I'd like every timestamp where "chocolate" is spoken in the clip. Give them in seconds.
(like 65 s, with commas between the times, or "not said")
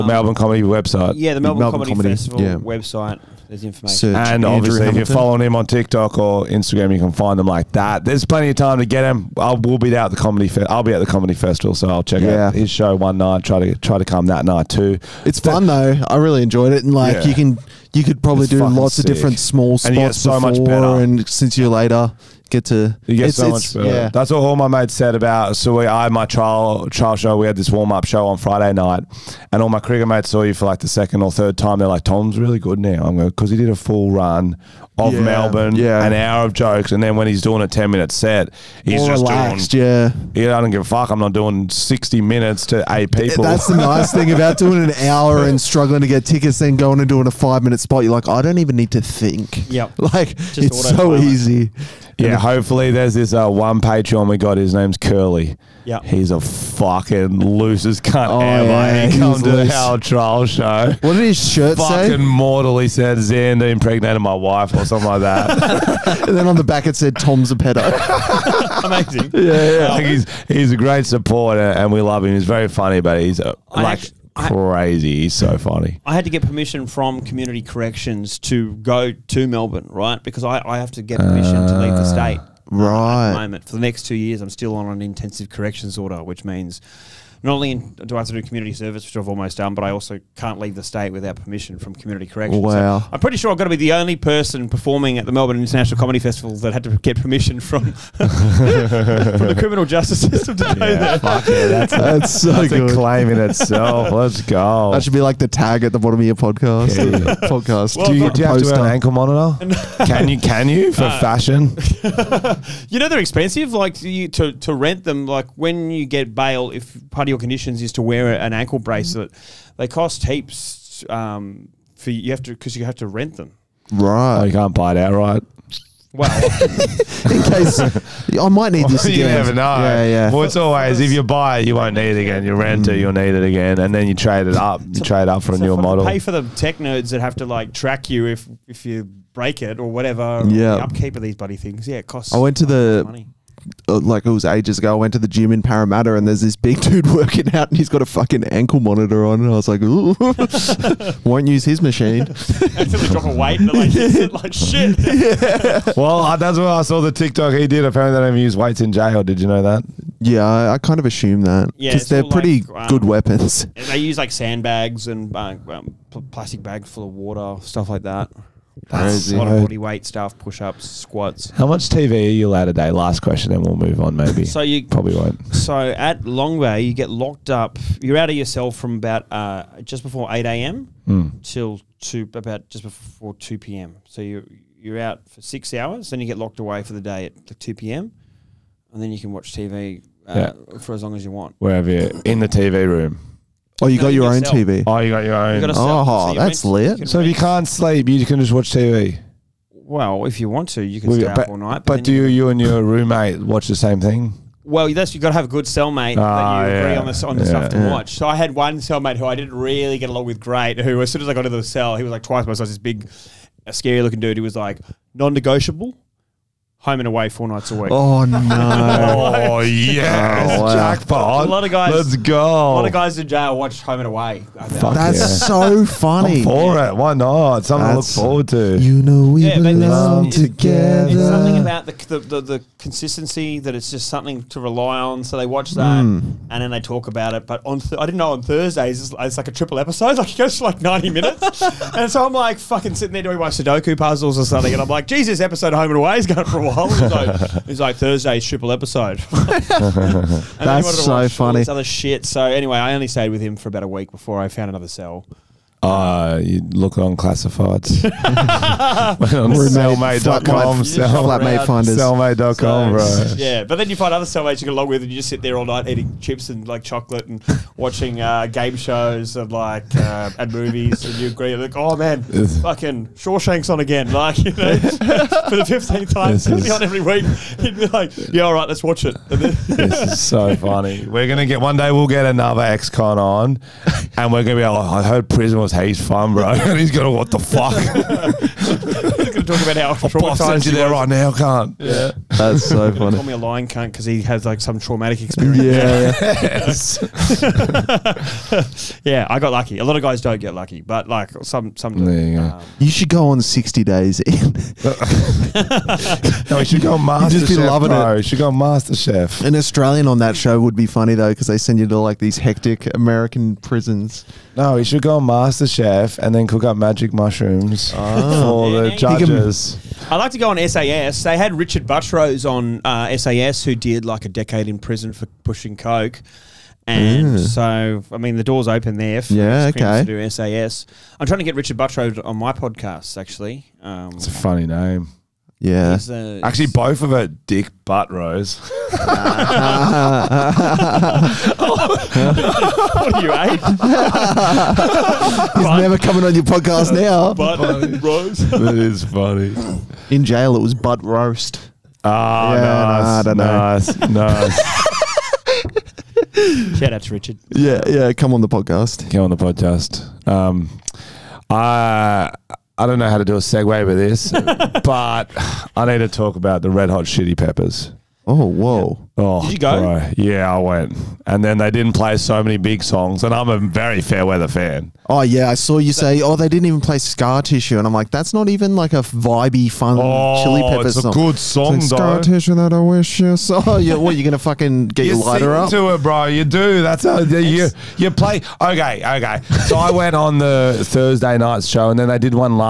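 266 s.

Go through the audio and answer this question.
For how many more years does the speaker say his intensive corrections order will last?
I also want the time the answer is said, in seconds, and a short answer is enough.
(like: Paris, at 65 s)
2, at 84 s.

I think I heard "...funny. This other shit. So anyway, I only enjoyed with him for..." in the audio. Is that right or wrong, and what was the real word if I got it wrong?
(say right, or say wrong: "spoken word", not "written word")
wrong: "stayed", not "enjoyed".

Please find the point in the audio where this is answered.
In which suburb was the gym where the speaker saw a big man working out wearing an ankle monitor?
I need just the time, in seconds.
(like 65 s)
145 s.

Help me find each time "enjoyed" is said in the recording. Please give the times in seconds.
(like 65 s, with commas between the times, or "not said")
16 s.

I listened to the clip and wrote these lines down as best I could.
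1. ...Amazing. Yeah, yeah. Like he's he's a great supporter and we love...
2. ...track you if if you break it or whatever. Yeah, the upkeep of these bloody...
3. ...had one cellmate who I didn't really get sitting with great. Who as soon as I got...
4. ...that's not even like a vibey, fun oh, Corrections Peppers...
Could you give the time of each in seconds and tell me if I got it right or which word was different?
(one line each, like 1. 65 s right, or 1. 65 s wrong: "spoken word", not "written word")
1. 68 s right
2. 137 s right
3. 208 s wrong: "along", not "sitting"
4. 378 s wrong: "Chili", not "Corrections".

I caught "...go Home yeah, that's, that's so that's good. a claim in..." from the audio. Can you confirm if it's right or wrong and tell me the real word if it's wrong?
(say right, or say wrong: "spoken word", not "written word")
wrong: "Fuck", not "Home".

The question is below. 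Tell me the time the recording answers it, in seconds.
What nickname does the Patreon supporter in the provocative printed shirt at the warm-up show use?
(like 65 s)
54 s.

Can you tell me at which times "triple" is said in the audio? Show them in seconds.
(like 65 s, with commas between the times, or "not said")
239 s, 248 s.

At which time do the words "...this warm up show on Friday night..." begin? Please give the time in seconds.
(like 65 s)
27 s.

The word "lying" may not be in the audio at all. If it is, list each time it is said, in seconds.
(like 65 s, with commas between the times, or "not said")
293 s.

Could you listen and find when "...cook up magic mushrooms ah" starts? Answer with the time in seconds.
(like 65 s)
316 s.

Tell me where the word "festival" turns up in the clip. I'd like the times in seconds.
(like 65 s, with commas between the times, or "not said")
2 s, 11 s, 96 s.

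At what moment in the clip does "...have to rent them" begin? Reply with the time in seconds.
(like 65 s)
122 s.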